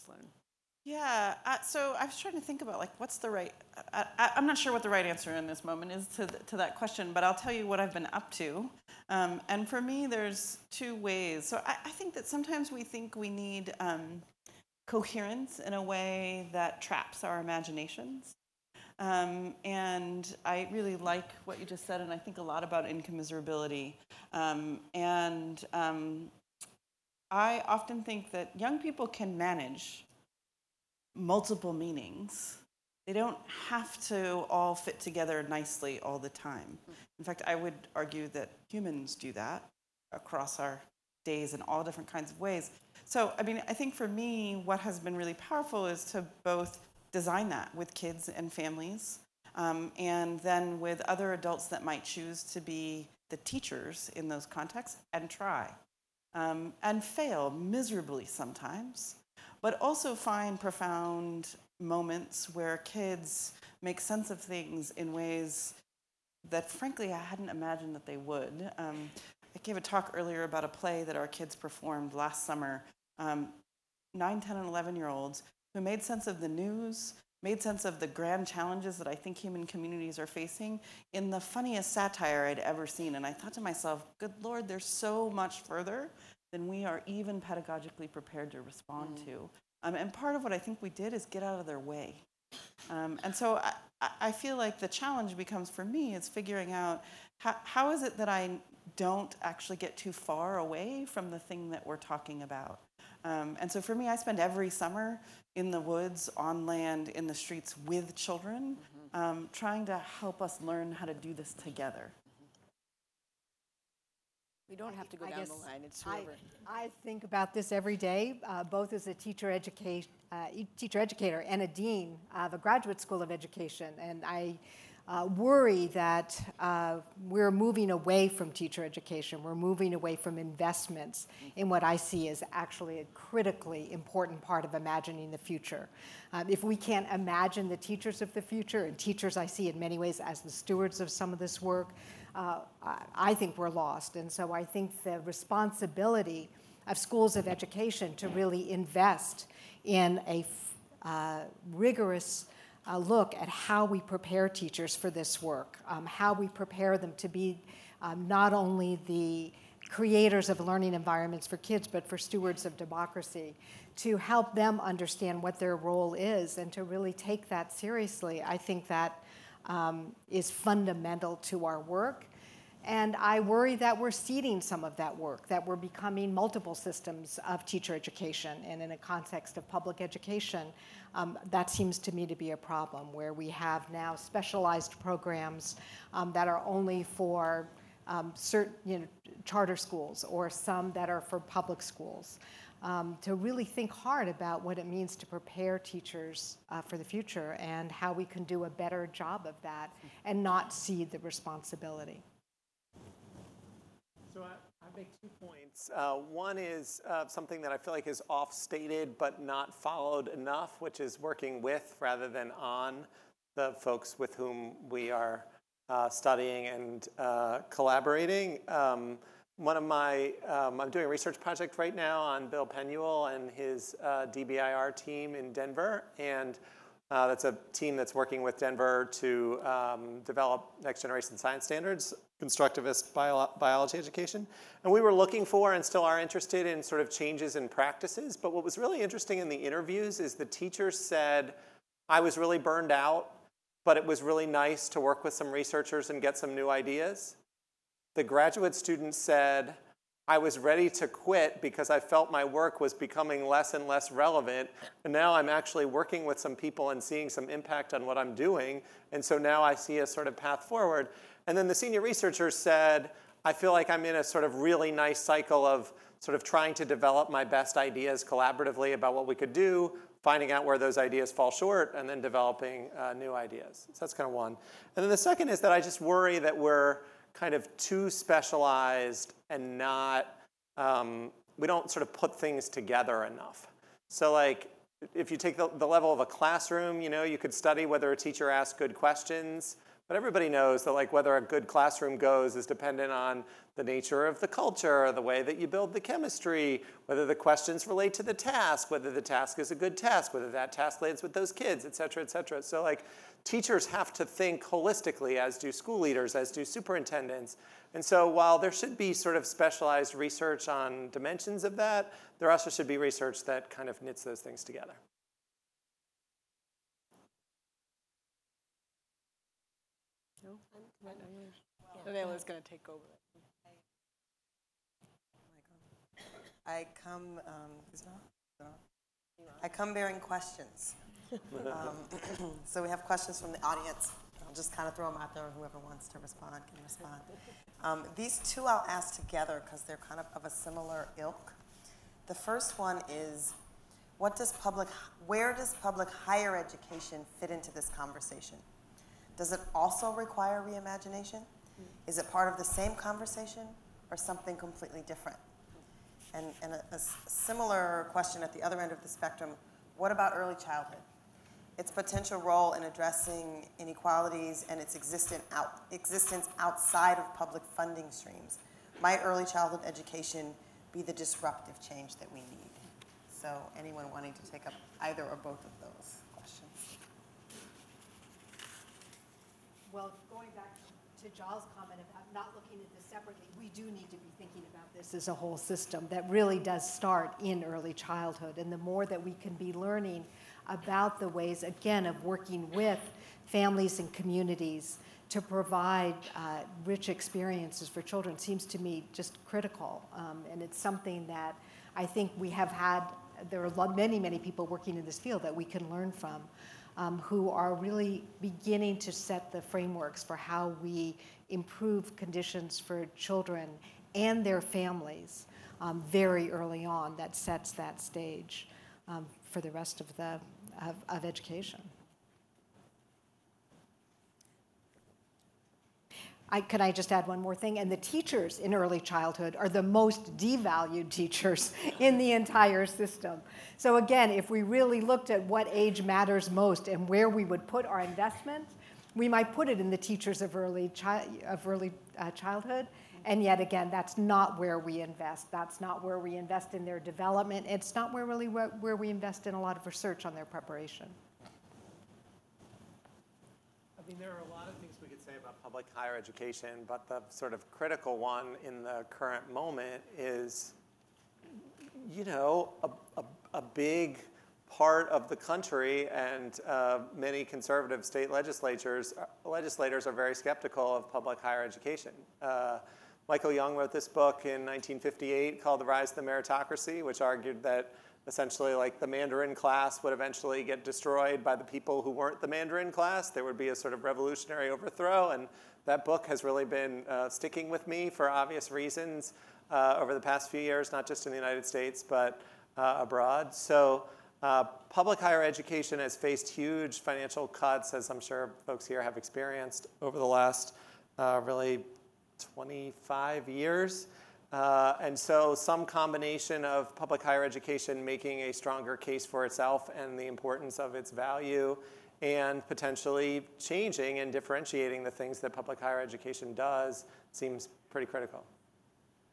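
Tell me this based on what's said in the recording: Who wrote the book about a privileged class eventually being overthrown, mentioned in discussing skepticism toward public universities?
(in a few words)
Michael Young.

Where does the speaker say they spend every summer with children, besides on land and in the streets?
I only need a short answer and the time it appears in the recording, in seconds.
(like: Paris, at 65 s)
the woods, at 105 s.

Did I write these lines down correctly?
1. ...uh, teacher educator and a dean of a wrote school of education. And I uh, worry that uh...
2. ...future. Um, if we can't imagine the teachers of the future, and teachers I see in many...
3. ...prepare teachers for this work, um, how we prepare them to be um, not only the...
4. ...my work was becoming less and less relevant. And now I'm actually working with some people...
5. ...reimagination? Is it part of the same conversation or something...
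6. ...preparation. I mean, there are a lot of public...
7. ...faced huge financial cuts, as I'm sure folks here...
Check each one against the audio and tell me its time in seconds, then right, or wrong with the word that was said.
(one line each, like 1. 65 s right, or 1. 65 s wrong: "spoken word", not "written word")
1. 119 s wrong: "graduate", not "wrote"
2. 135 s right
3. 154 s right
4. 252 s right
5. 350 s right
6. 450 s right
7. 496 s right.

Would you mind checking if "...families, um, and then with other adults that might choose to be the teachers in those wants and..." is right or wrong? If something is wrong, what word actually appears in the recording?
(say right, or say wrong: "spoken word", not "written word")
wrong: "contexts", not "wants".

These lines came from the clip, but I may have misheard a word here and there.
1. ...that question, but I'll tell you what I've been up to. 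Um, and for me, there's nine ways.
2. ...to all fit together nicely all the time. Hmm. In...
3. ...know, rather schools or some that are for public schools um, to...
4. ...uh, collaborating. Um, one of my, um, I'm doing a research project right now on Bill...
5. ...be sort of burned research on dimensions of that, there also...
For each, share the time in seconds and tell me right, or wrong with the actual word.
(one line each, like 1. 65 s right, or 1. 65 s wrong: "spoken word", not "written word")
1. 6 s wrong: "two", not "nine"
2. 34 s right
3. 189 s wrong: "charter", not "rather"
4. 217 s right
5. 308 s wrong: "specialized", not "burned".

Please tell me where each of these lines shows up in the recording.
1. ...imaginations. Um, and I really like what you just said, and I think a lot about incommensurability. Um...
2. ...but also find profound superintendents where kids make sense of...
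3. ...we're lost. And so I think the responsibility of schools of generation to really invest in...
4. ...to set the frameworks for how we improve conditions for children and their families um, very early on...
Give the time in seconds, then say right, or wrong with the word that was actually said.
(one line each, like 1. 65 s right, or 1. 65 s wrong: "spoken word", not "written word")
1. 17 s right
2. 59 s wrong: "moments", not "superintendents"
3. 143 s wrong: "education", not "generation"
4. 408 s right.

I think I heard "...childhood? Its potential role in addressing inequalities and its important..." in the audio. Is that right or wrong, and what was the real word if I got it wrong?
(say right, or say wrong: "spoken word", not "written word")
wrong: "existent", not "important".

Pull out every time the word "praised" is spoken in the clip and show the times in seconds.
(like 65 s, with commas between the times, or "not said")
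not said.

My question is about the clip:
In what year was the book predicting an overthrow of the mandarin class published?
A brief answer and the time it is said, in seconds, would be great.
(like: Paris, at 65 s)
1958, at 474 s.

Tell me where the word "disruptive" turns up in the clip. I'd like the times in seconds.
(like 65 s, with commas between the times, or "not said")
371 s.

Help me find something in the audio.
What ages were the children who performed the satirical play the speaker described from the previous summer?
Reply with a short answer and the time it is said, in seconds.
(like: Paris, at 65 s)
9, 10, and 11, at 74 s.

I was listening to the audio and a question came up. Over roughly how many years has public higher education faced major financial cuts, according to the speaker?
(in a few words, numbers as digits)
25 years.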